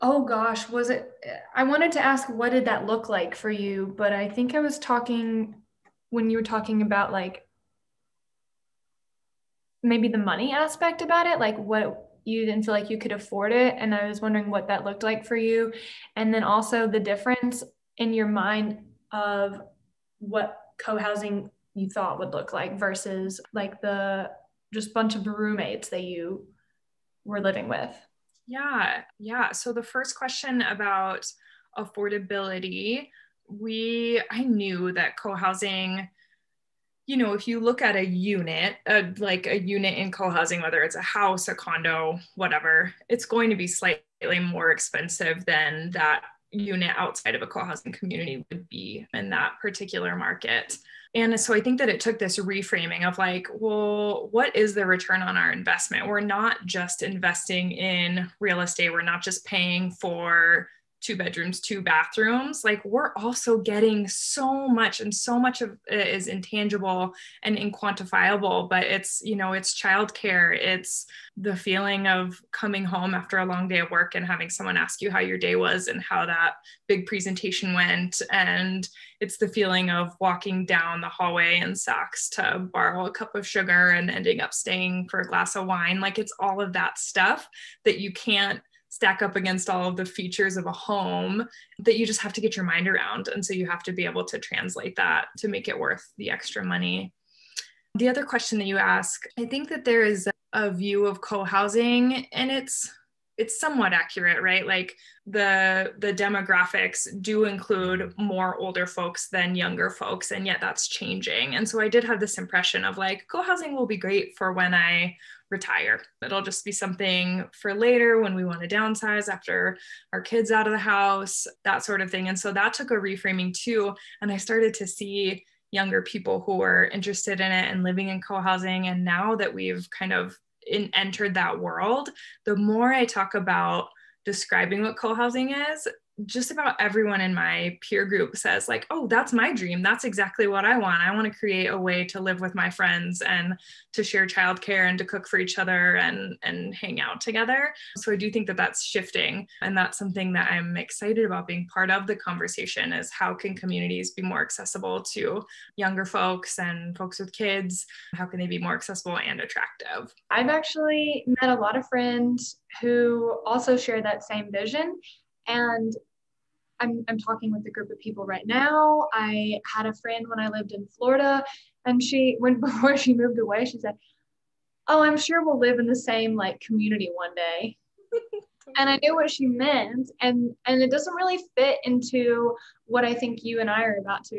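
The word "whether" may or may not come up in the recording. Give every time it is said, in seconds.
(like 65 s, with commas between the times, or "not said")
40 s.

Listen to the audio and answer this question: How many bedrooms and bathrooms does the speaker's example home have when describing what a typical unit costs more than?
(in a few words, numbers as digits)
2 bedrooms, 2 bathrooms.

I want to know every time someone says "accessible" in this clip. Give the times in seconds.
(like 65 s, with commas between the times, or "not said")
154 s, 158 s.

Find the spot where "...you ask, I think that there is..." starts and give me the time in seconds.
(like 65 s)
98 s.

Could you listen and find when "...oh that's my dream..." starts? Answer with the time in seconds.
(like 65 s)
138 s.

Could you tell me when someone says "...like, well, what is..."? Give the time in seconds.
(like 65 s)
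53 s.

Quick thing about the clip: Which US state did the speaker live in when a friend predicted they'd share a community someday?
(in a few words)
Florida.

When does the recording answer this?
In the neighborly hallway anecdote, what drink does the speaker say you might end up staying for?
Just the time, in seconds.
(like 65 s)
85 s.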